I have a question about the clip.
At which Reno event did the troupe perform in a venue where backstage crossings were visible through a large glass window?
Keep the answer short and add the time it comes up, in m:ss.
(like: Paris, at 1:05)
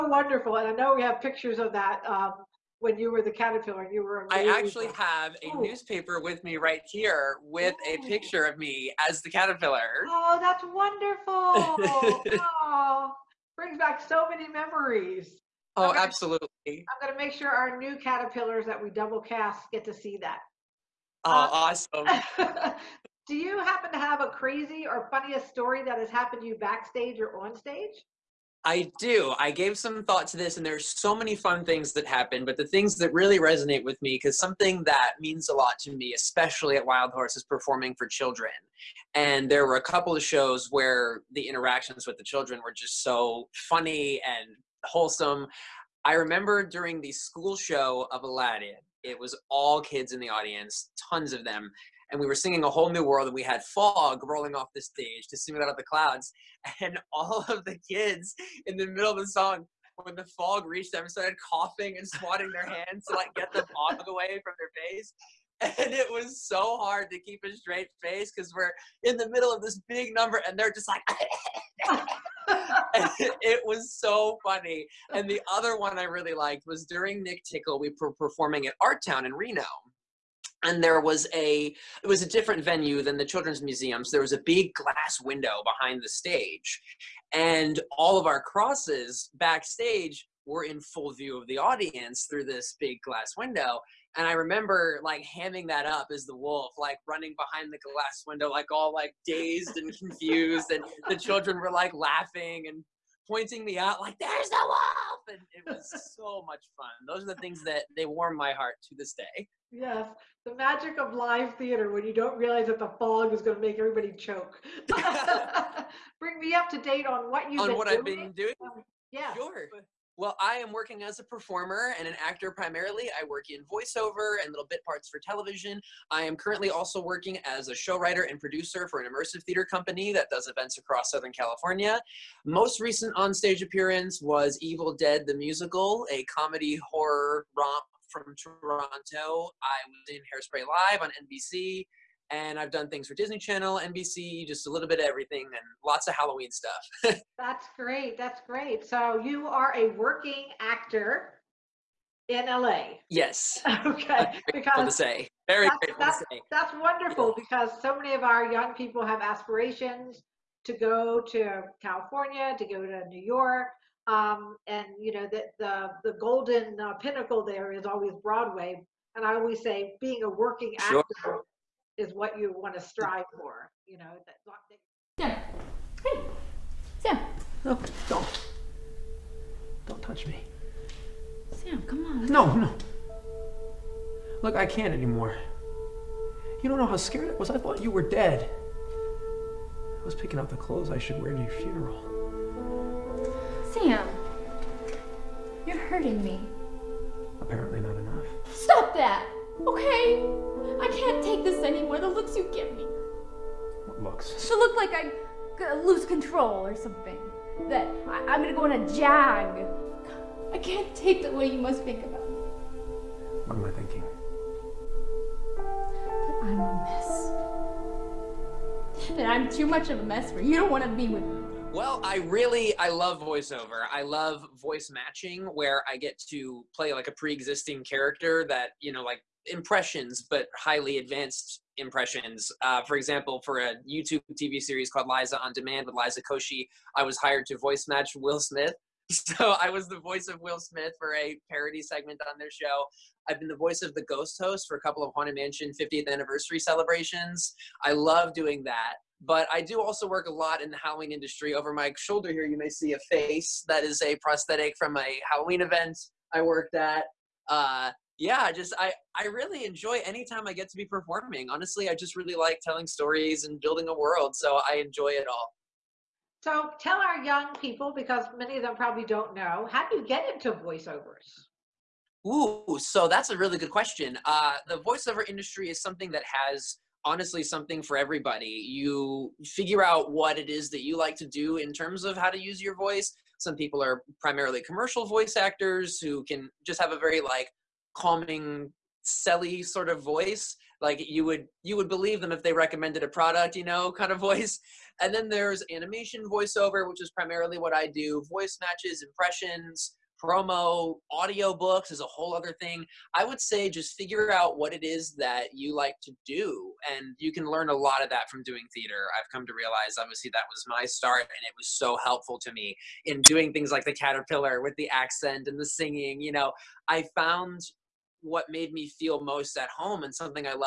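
Artown, at 1:18.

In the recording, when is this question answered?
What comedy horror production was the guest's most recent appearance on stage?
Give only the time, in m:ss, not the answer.
2:14.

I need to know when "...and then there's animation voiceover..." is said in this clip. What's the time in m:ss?
4:55.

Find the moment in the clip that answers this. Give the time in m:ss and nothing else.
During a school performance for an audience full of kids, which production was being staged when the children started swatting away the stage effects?
0:48.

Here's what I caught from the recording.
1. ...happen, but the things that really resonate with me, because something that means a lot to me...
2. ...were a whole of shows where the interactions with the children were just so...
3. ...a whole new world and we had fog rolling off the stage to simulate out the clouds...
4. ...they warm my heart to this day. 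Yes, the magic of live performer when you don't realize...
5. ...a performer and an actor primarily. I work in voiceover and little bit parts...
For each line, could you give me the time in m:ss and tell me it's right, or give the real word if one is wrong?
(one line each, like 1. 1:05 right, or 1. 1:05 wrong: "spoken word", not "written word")
1. 0:32 right
2. 0:39 wrong: "couple", not "whole"
3. 0:52 right
4. 1:47 wrong: "theater", not "performer"
5. 2:01 right.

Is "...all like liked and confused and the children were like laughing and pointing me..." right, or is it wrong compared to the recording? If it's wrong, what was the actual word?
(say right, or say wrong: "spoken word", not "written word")
wrong: "dazed", not "liked".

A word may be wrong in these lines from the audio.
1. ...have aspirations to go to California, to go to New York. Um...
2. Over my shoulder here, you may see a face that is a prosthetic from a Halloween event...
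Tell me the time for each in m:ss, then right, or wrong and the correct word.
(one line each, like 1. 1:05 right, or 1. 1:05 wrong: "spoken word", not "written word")
1. 2:39 right
2. 4:11 right.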